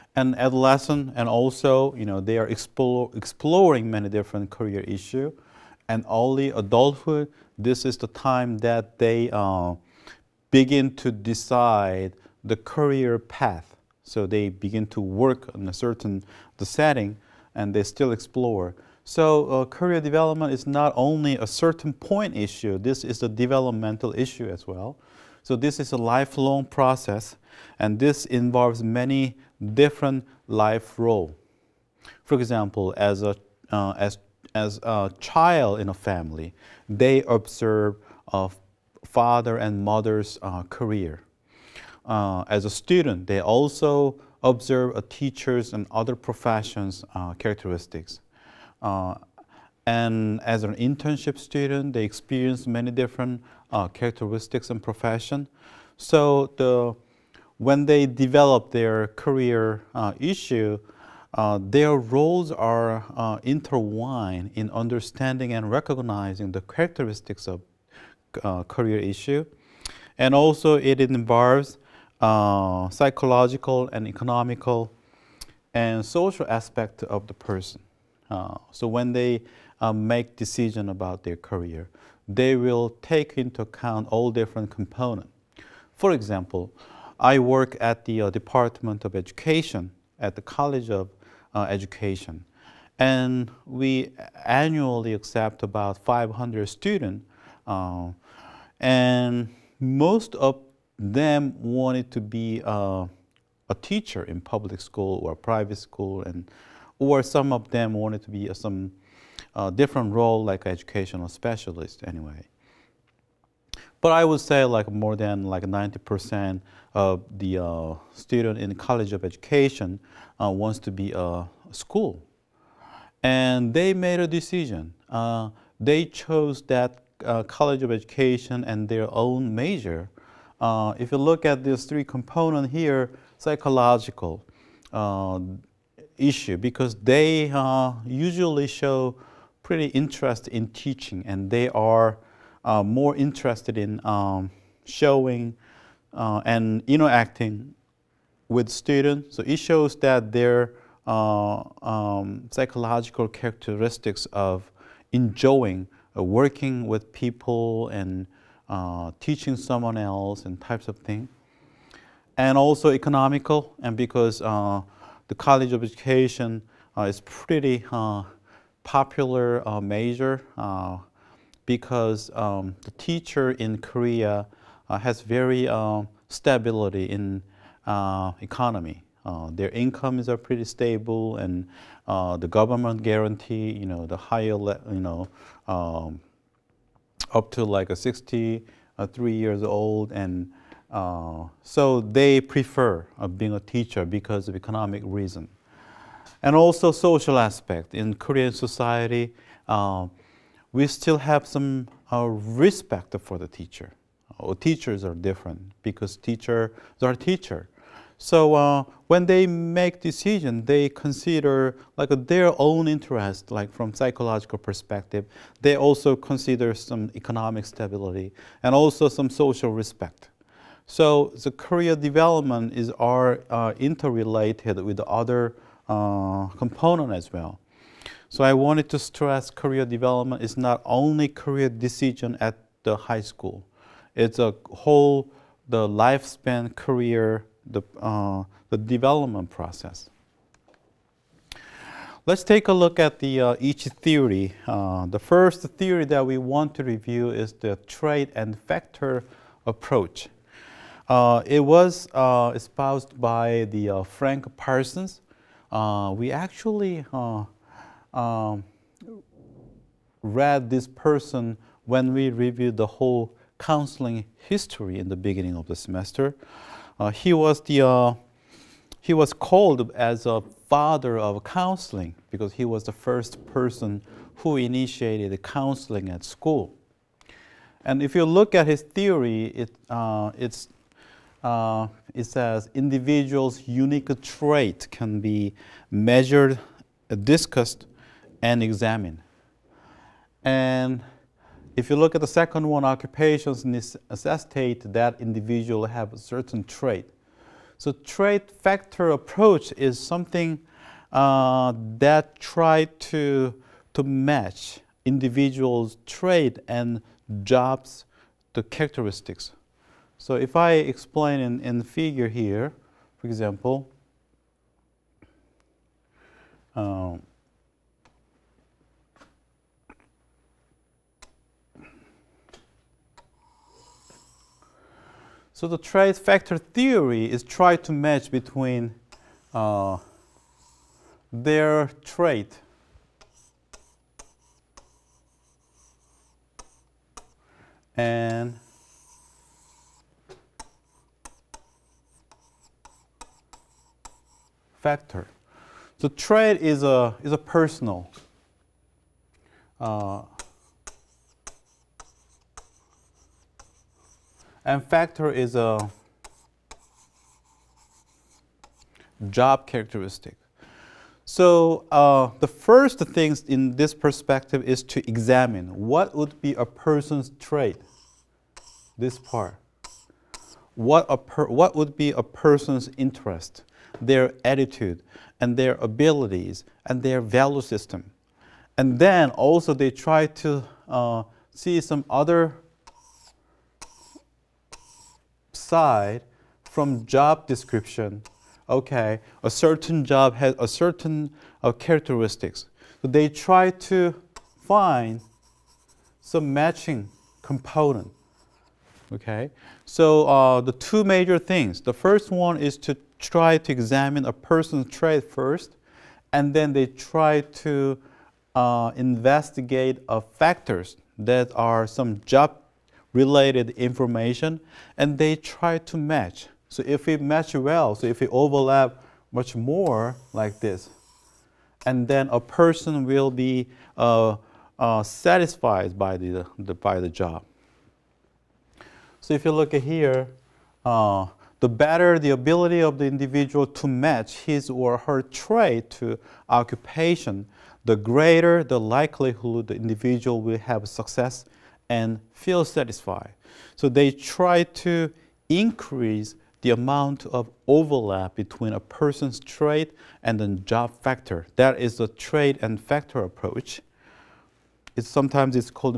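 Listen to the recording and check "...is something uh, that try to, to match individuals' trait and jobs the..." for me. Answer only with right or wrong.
right.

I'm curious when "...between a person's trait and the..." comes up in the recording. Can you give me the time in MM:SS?
07:28.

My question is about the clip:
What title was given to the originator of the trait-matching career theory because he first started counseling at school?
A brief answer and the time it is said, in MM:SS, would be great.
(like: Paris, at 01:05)
father of counseling, at 04:30.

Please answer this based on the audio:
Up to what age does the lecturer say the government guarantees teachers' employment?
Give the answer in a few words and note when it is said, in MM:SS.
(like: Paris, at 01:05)
63, at 03:07.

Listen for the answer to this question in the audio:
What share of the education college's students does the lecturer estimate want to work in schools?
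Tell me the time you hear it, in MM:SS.
01:54.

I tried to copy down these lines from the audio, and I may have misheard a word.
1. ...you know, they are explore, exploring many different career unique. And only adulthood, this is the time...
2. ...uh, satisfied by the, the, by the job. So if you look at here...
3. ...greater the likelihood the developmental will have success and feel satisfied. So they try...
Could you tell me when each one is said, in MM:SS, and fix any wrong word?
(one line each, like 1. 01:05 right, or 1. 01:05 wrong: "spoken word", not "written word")
1. 00:01 wrong: "issue", not "unique"
2. 07:04 right
3. 07:17 wrong: "individual", not "developmental".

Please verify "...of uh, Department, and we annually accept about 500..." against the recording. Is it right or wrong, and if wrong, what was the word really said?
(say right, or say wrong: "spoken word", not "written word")
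wrong: "Education", not "Department".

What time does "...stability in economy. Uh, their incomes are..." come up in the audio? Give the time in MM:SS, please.
02:56.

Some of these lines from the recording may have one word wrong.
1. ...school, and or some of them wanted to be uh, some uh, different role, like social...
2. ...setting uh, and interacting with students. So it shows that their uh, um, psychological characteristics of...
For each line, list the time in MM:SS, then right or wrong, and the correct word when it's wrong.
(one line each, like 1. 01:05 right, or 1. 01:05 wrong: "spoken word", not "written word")
1. 01:45 wrong: "educational", not "social"
2. 02:24 wrong: "showing", not "setting".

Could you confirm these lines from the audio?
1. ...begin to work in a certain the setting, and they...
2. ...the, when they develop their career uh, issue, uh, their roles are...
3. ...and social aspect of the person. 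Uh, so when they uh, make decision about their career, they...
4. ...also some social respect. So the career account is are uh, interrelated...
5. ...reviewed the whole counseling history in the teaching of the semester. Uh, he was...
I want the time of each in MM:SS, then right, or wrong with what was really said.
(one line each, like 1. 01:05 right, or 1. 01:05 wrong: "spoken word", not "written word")
1. 00:14 right
2. 00:56 right
3. 01:15 right
4. 03:38 wrong: "development", not "account"
5. 04:22 wrong: "beginning", not "teaching".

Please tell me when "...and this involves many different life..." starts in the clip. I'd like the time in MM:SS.
00:27.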